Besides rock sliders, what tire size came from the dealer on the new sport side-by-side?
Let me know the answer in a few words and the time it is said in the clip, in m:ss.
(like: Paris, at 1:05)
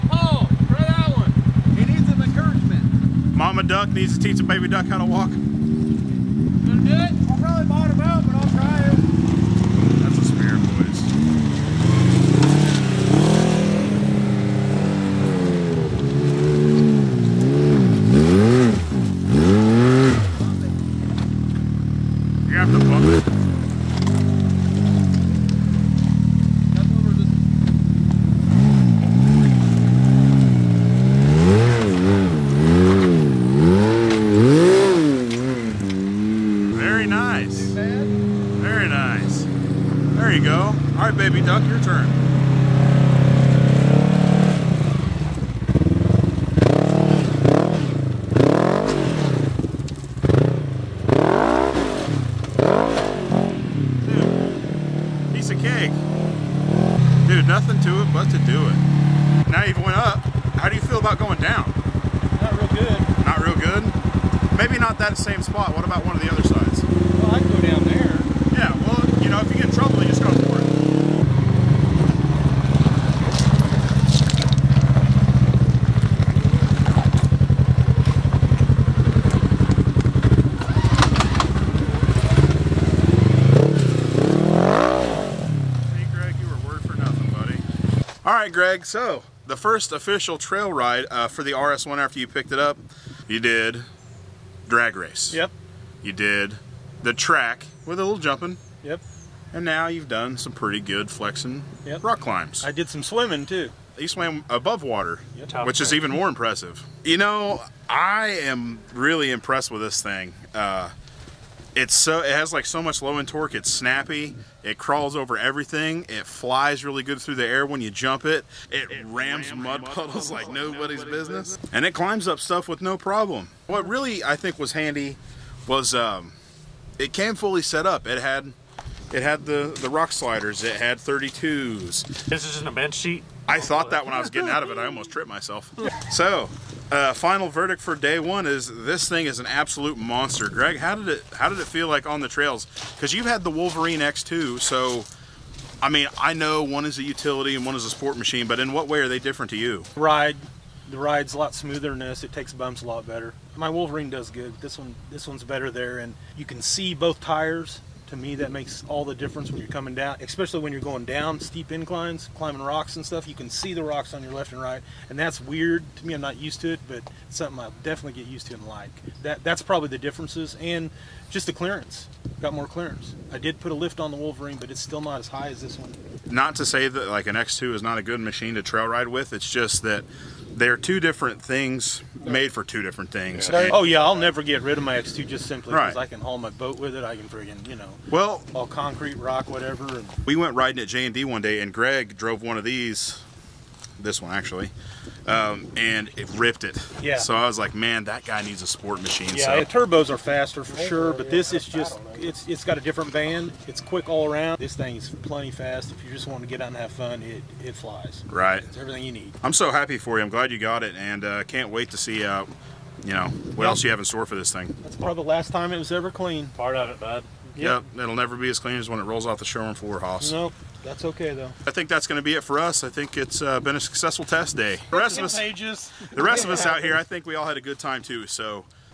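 32s, at 2:10.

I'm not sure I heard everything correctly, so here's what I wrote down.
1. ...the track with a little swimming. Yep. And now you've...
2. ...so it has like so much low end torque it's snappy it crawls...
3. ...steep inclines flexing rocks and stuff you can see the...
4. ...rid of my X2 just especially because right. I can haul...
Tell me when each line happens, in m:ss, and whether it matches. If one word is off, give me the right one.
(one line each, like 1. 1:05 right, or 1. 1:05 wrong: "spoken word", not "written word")
1. 1:37 wrong: "jumping", not "swimming"
2. 1:51 right
3. 2:41 wrong: "climbing", not "flexing"
4. 3:04 wrong: "simply", not "especially".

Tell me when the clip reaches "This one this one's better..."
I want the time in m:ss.
2:34.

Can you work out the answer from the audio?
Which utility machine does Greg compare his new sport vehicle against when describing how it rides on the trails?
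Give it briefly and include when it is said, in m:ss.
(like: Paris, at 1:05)
Wolverine X2, at 2:23.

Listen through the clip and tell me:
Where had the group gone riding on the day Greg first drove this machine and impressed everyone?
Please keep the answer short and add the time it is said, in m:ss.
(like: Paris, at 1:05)
J and D, at 3:10.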